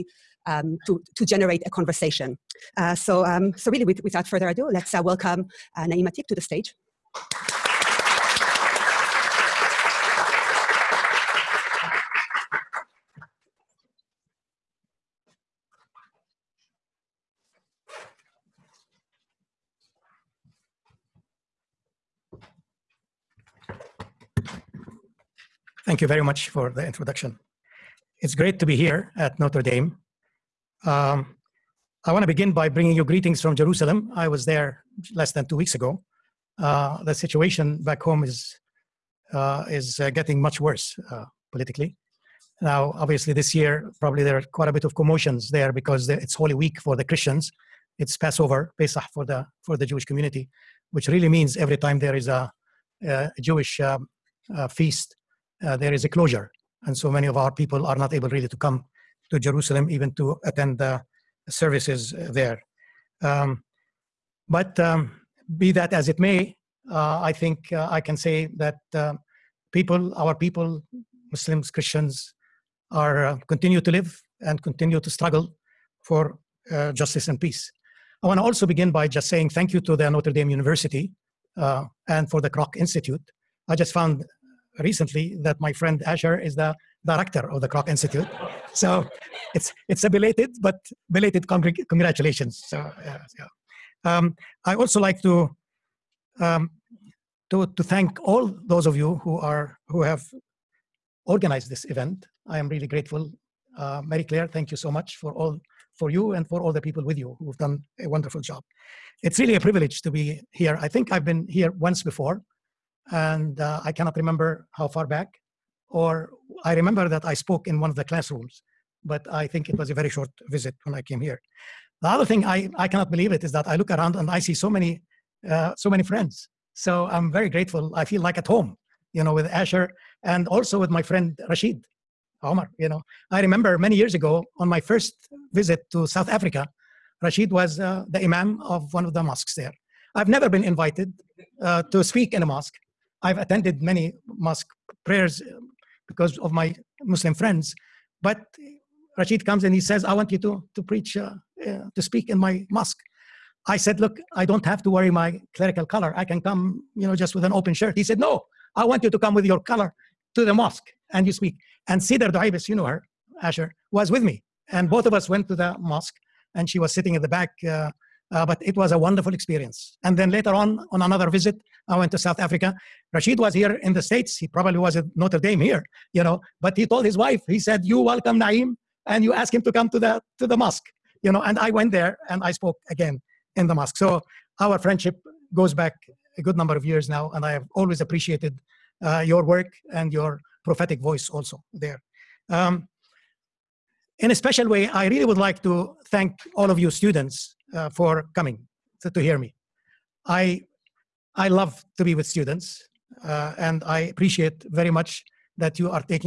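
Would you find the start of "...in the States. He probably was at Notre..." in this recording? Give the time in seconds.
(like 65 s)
173 s.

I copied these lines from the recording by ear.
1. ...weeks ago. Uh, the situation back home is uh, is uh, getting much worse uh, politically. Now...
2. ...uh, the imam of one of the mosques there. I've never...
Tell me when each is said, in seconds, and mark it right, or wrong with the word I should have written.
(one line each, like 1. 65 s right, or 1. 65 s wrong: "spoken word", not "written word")
1. 35 s right
2. 137 s right.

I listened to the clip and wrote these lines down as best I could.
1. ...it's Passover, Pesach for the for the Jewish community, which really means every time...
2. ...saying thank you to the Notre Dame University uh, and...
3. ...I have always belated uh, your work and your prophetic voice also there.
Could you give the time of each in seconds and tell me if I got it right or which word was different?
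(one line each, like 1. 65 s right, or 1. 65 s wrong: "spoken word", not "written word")
1. 47 s right
2. 79 s right
3. 187 s wrong: "appreciated", not "belated".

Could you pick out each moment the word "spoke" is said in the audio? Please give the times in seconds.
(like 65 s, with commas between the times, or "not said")
117 s, 182 s.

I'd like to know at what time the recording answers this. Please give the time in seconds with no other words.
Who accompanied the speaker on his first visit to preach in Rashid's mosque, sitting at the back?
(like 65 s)
162 s.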